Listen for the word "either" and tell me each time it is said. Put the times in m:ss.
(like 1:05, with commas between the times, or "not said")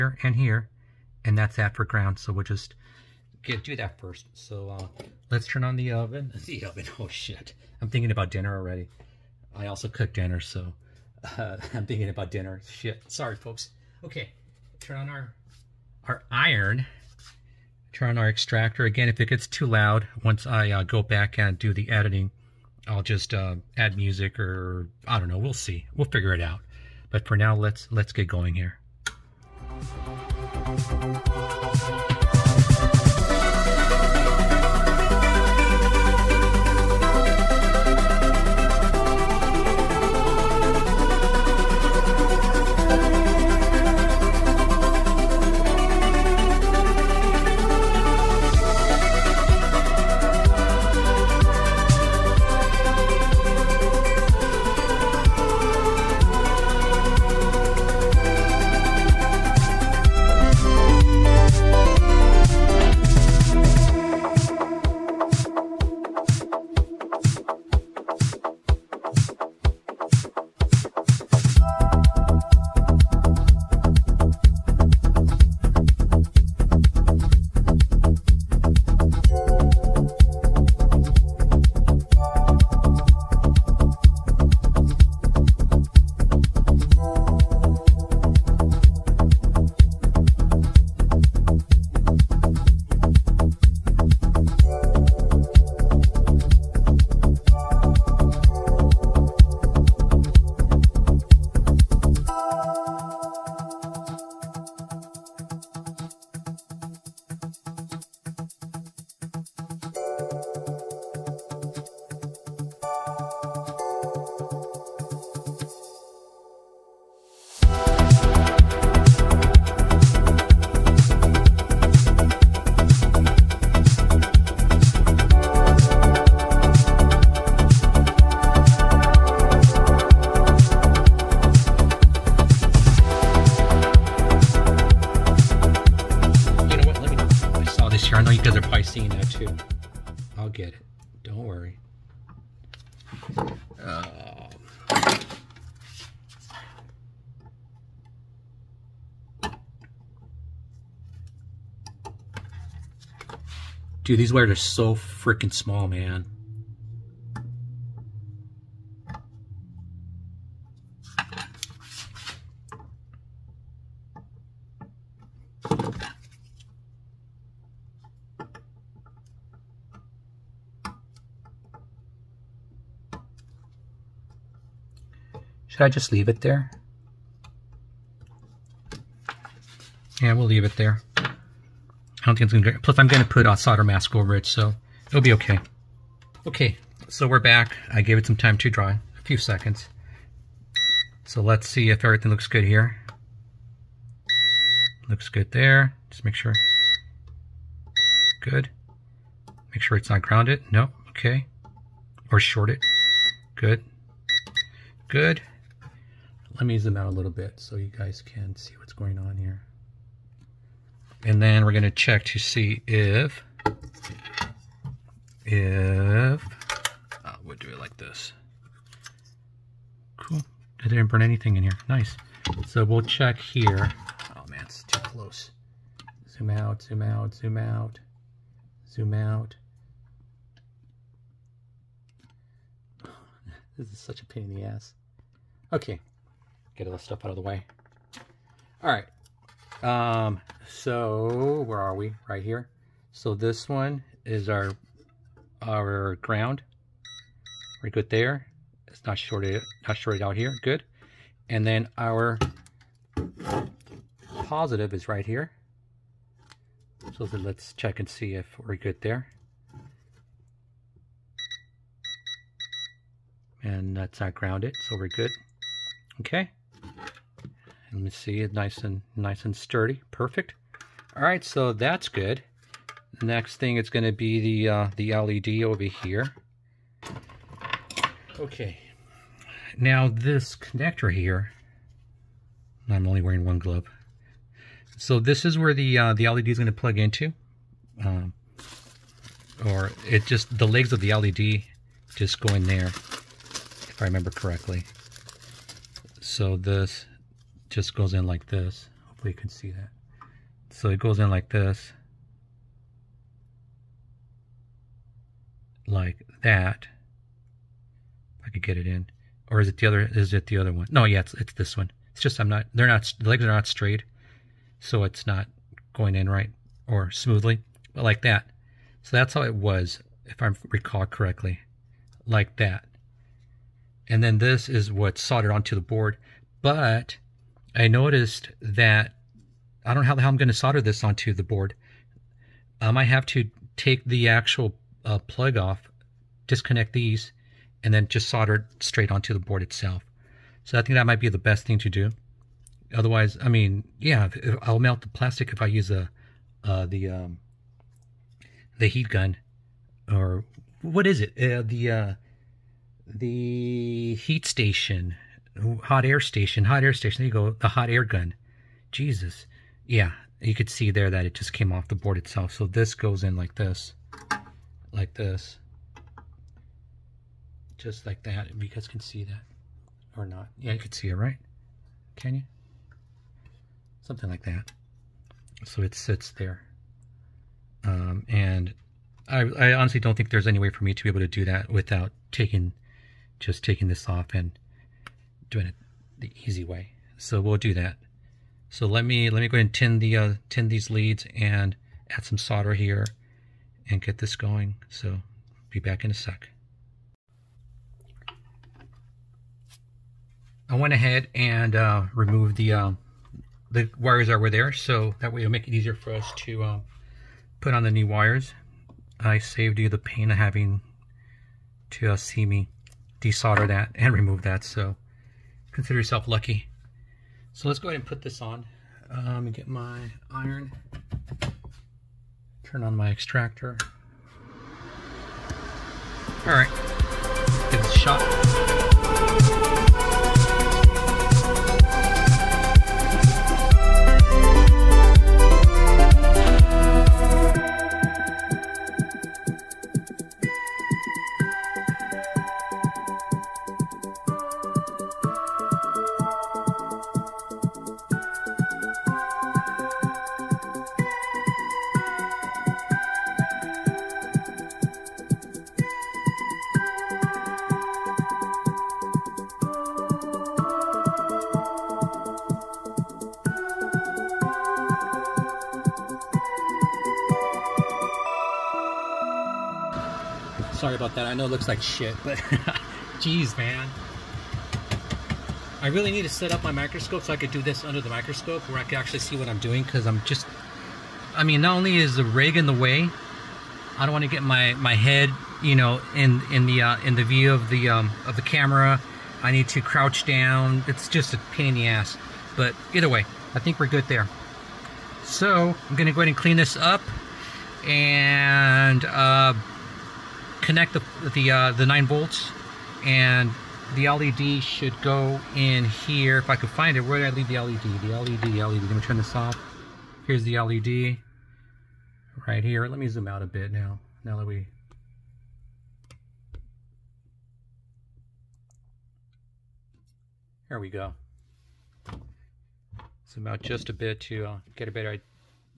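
8:12.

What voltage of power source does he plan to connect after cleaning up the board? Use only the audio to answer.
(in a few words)
9 volts.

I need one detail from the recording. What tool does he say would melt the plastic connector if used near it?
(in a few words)
hot air gun.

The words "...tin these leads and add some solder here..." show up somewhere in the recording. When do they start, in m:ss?
6:30.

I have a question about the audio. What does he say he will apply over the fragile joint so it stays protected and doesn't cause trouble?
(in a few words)
solder mask.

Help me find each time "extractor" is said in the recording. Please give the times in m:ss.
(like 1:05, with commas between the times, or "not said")
0:18, 7:03.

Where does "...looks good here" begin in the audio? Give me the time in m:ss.
3:12.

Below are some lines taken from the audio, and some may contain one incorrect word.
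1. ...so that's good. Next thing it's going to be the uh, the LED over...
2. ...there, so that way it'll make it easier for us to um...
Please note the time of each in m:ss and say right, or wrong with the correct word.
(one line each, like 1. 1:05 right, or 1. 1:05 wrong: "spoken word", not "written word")
1. 4:31 right
2. 6:44 right.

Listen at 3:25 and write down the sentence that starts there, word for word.
Good let me use them out a little bit so you guys can see what's going on here.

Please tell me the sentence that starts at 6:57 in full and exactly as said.
So let's go ahead and put this on um, and get my iron.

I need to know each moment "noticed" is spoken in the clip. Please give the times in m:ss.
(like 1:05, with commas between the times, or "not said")
5:27.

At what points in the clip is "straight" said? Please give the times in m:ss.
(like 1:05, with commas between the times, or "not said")
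5:13, 5:38.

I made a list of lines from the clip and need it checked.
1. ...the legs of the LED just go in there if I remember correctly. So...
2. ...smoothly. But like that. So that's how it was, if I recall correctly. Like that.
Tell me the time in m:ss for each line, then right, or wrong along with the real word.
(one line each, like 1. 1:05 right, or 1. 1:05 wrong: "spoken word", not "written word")
1. 4:50 right
2. 5:17 right.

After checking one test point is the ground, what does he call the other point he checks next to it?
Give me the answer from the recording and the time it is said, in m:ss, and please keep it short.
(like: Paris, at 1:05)
positive, at 4:14.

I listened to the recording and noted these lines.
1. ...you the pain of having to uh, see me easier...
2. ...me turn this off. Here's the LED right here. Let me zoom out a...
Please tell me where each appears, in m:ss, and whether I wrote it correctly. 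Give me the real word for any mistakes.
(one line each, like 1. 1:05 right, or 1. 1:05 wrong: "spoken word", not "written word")
1. 6:49 wrong: "desolder", not "easier"
2. 8:28 right.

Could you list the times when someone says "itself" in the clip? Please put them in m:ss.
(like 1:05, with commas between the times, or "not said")
5:39, 6:02.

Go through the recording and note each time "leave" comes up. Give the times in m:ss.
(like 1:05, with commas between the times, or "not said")
2:56, 3:00, 8:27.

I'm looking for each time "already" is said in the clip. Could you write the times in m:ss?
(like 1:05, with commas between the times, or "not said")
0:08.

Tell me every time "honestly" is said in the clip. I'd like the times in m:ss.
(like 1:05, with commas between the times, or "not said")
6:19.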